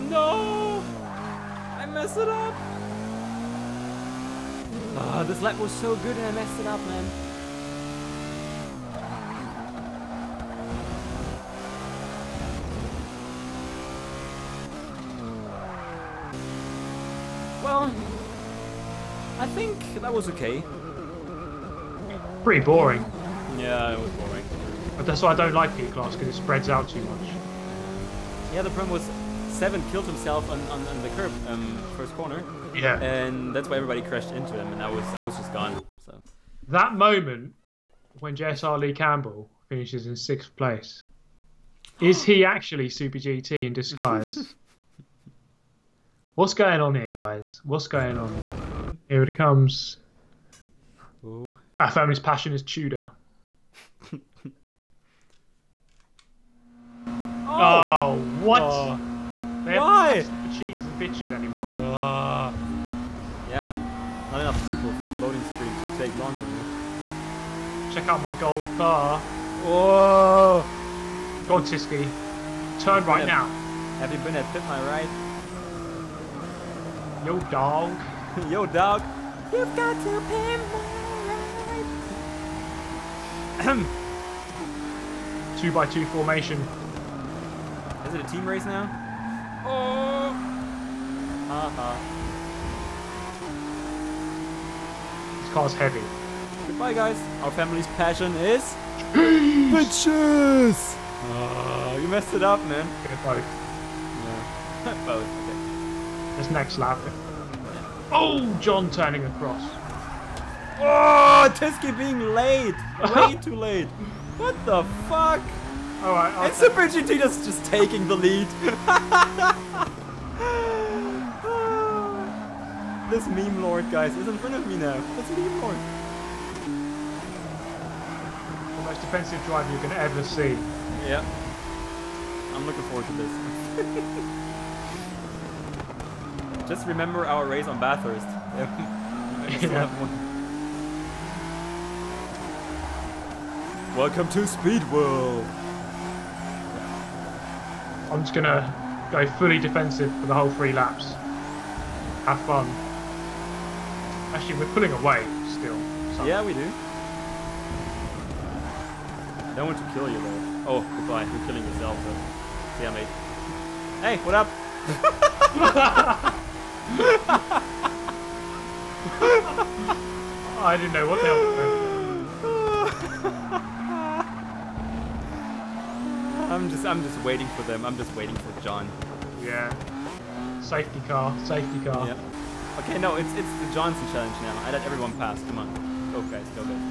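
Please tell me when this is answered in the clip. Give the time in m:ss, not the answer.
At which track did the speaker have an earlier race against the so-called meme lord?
2:17.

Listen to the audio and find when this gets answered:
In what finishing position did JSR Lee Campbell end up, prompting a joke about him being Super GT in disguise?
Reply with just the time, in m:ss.
0:40.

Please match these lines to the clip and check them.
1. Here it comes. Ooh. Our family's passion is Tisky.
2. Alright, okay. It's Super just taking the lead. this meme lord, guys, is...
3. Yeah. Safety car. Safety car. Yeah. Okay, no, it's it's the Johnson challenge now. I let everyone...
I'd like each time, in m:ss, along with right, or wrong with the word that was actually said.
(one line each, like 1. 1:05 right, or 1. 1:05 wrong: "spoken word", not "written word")
1. 0:49 wrong: "Tudor", not "Tisky"
2. 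1:56 right
3. 2:59 right.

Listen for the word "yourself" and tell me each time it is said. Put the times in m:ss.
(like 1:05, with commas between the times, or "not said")
2:41.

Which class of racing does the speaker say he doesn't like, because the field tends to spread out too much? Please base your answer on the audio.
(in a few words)
P-Class.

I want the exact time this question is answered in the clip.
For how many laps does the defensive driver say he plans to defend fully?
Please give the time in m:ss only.
2:30.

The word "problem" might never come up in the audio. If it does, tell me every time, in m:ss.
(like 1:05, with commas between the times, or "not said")
0:28.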